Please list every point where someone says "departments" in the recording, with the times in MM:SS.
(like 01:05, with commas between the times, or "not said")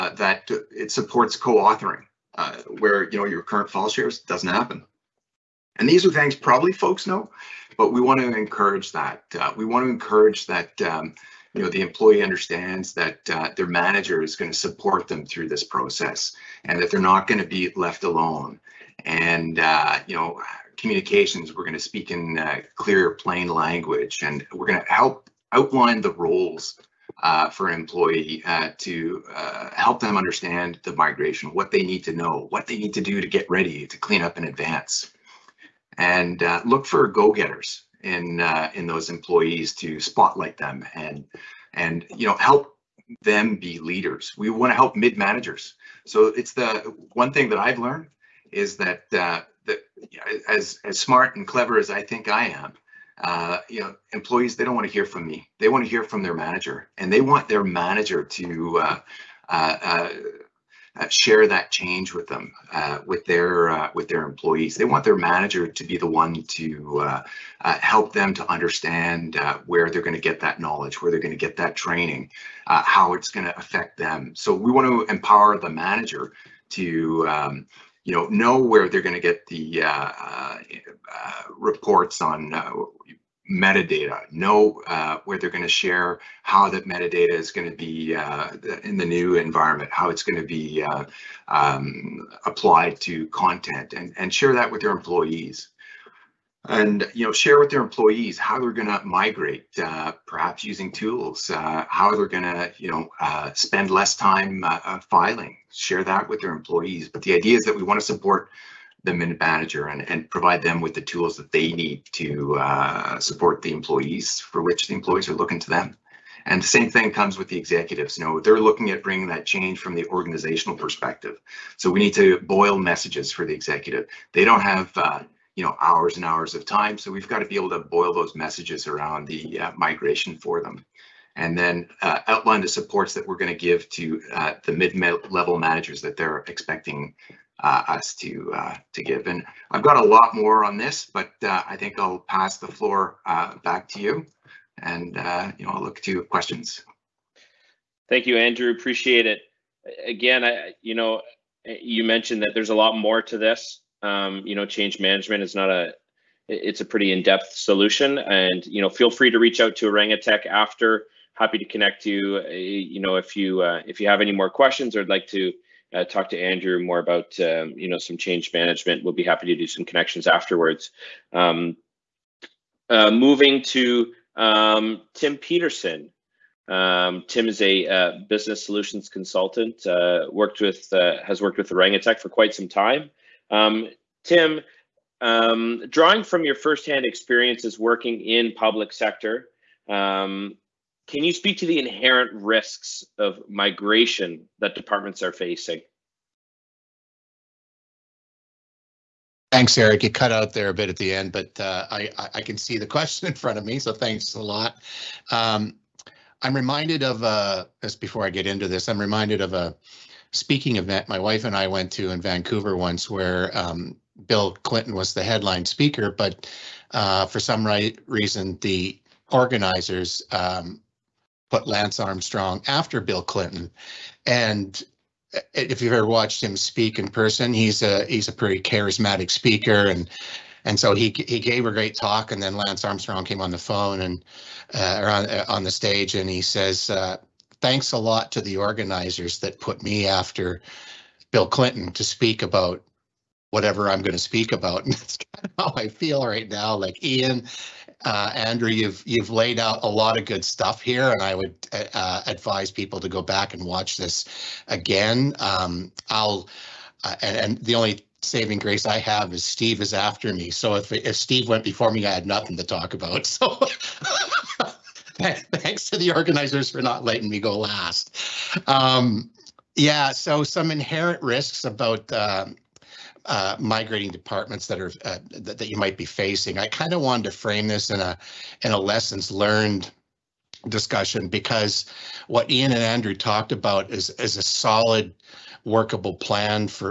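03:14, 04:34.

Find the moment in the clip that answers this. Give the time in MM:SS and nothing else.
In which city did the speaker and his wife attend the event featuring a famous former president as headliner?
03:32.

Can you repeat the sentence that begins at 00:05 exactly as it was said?
And these are things probably folks know, but we want to encourage that.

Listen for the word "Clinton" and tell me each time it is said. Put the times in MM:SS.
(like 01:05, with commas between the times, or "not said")
03:34, 03:43, 04:01.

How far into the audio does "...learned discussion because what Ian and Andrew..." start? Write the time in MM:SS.
04:39.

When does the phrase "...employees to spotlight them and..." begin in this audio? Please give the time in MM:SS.
00:39.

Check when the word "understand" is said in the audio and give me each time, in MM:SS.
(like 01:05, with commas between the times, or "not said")
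00:12, 00:30, 01:08.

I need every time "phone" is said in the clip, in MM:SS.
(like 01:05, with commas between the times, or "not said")
03:53.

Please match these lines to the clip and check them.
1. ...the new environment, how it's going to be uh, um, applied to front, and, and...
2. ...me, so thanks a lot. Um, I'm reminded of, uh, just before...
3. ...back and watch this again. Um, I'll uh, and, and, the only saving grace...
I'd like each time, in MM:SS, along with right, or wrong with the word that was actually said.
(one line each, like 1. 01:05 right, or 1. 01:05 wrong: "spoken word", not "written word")
1. 01:28 wrong: "content", not "front"
2. 03:23 right
3. 04:13 right.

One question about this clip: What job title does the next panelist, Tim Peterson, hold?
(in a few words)
Business solutions consultant.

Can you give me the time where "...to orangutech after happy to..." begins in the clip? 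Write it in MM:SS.
02:39.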